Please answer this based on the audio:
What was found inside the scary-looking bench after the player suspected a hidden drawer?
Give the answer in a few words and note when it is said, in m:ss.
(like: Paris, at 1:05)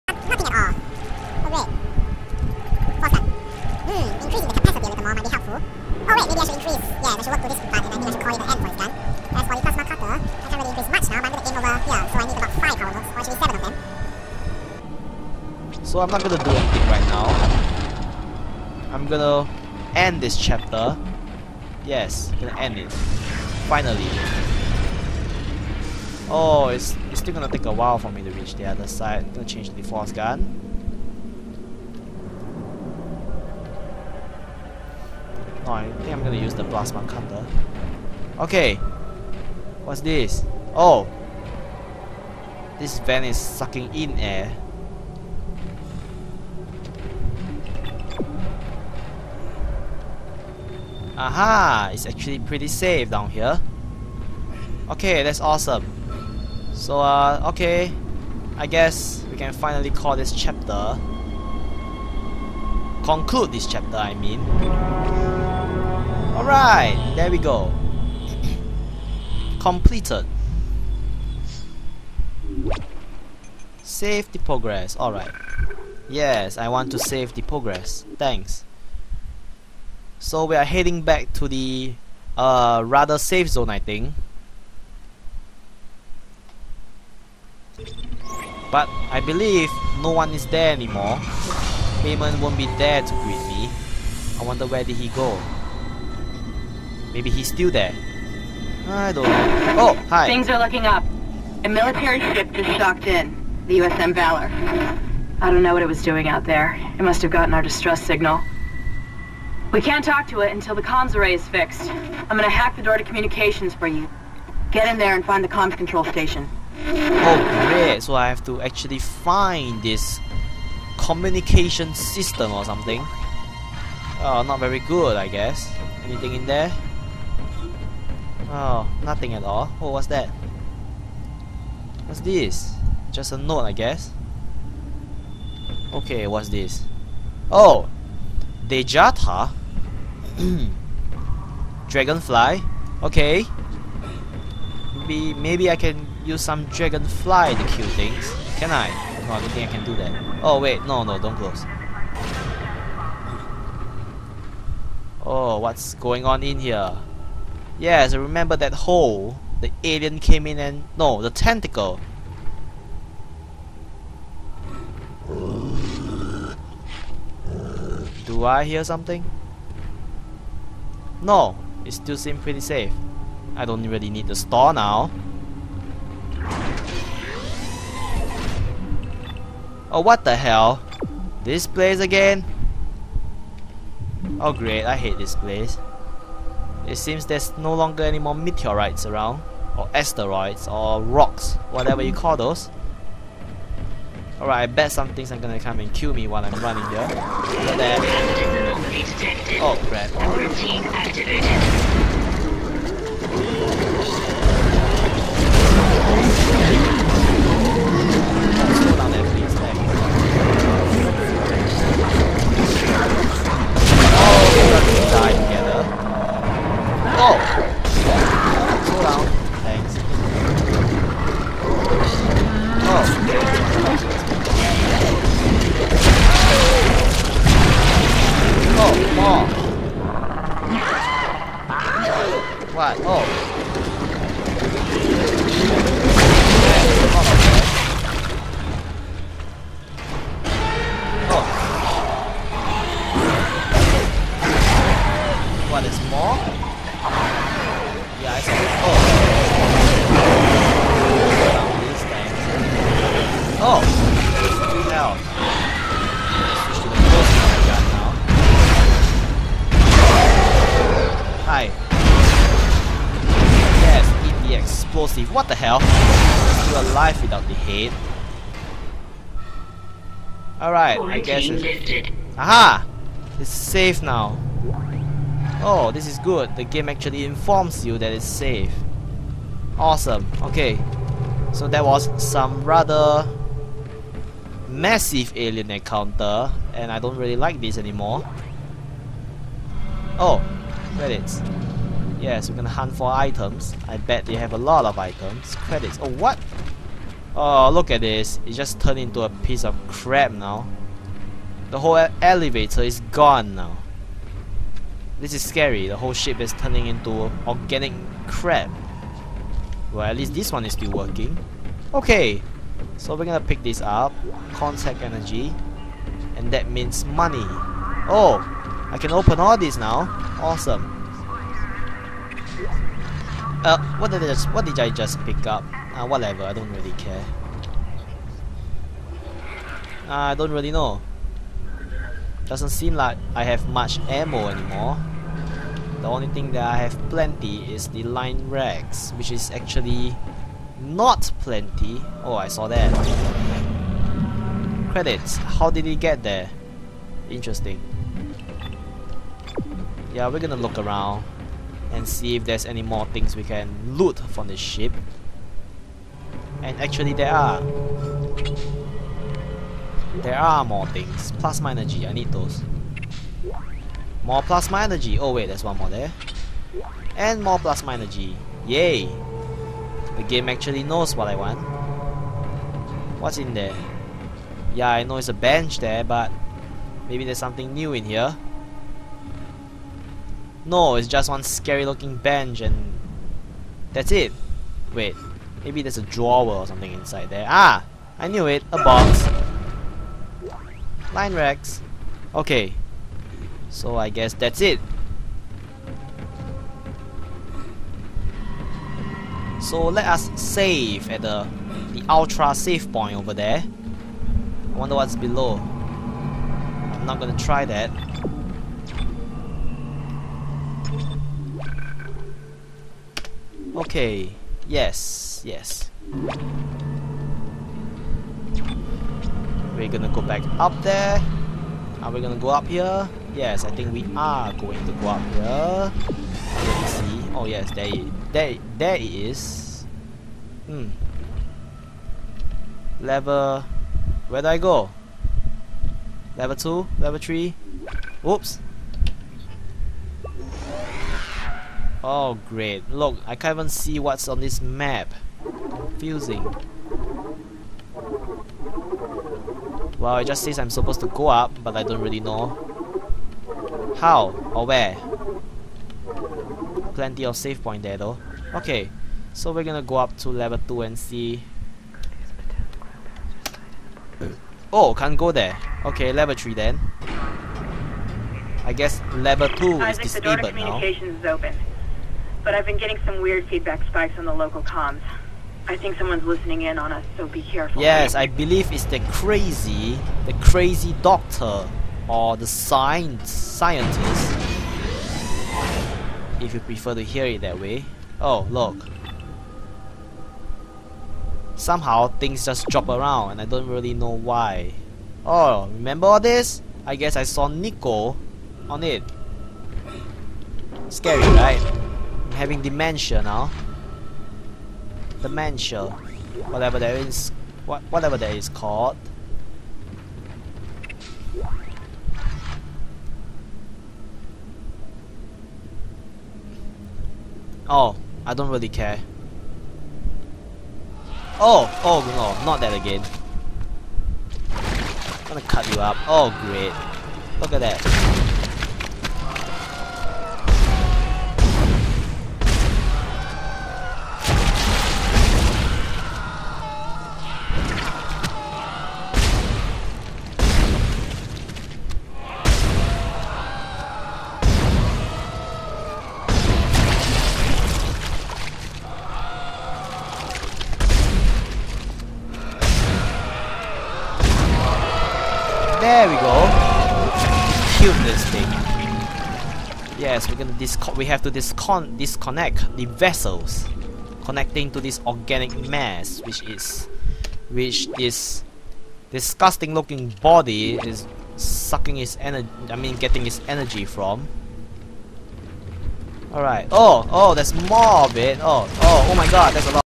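a box, at 6:28.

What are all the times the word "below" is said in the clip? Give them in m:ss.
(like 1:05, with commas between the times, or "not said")
6:45.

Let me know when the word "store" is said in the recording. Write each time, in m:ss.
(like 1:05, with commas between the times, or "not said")
2:54.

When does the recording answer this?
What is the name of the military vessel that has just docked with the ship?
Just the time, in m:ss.
1:43.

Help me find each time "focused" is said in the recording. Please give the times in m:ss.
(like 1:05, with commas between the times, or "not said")
not said.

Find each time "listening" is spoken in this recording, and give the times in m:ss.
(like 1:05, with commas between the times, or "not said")
7:56.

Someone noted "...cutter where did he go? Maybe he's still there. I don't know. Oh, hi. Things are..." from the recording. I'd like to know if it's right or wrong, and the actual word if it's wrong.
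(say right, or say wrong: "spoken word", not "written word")
wrong: "wonder", not "cutter".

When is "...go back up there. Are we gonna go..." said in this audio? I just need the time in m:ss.
7:00.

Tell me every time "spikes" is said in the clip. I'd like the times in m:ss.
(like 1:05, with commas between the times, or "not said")
7:53.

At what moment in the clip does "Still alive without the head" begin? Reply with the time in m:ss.
4:26.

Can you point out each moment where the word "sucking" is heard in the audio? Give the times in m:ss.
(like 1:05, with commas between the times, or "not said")
0:43, 9:31.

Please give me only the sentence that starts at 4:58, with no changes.
It just turned into a piece of crap now.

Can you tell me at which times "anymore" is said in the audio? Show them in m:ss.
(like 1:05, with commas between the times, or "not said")
1:30, 4:47, 5:34.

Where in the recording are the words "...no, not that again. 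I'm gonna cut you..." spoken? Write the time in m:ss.
8:42.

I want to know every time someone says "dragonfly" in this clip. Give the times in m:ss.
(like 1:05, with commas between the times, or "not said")
2:21, 2:26.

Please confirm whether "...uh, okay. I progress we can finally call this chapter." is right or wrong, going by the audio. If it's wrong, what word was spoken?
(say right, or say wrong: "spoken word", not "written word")
wrong: "guess", not "progress".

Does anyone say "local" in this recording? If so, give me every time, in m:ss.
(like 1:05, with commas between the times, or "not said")
7:54.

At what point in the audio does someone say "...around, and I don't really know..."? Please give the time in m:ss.
8:12.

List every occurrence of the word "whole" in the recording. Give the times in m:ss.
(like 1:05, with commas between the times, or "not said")
5:01, 5:05.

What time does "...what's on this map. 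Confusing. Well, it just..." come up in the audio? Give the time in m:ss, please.
7:23.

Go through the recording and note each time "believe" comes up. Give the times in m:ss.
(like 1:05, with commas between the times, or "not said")
1:29, 7:58.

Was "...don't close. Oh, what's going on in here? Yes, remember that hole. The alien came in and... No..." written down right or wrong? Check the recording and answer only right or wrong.
right.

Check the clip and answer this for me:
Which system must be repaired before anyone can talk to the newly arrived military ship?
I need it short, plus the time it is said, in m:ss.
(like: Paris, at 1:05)
comms array, at 1:50.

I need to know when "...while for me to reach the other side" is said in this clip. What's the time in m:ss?
0:27.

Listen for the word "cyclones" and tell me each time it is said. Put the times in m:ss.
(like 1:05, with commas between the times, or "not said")
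not said.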